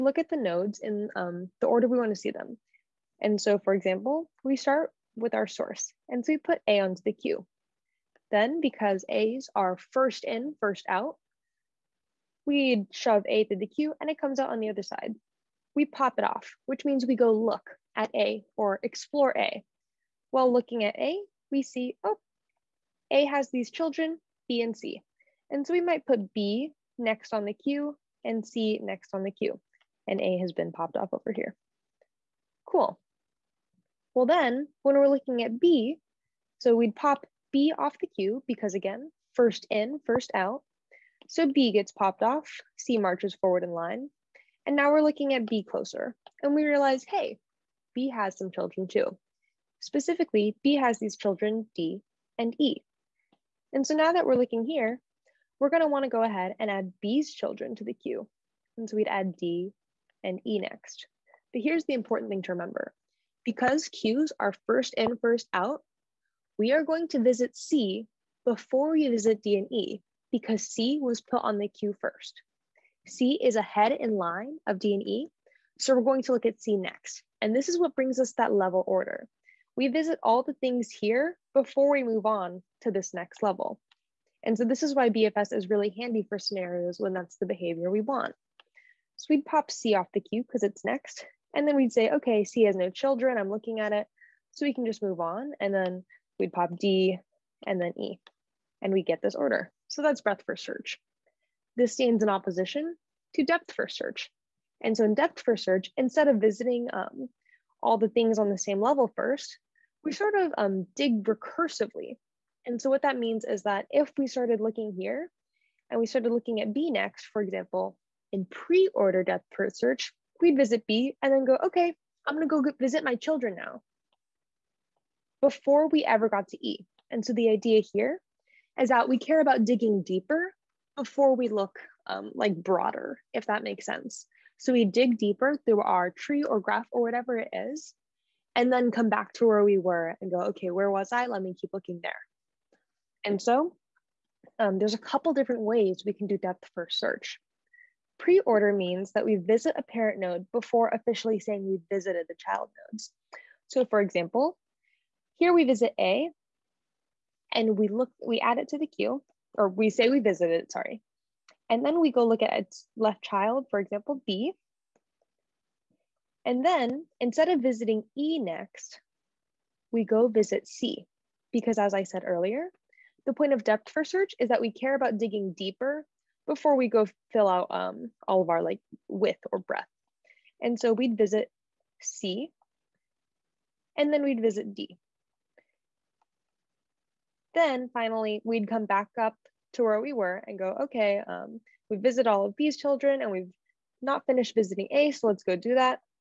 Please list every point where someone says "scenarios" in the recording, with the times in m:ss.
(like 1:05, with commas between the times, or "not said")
1:26.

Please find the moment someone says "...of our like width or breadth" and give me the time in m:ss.
2:58.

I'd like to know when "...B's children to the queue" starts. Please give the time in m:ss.
0:57.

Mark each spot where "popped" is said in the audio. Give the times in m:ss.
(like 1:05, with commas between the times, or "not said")
0:30, 0:41.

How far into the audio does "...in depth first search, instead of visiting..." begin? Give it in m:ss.
1:45.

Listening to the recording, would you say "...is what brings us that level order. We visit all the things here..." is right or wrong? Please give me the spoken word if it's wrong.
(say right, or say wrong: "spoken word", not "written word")
right.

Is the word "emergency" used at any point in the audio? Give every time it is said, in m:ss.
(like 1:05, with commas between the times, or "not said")
not said.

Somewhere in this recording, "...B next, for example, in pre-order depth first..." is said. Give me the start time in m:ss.
1:56.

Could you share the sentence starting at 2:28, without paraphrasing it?
Pre-order means that we visit a parent node before officially saying we visited the child nodes.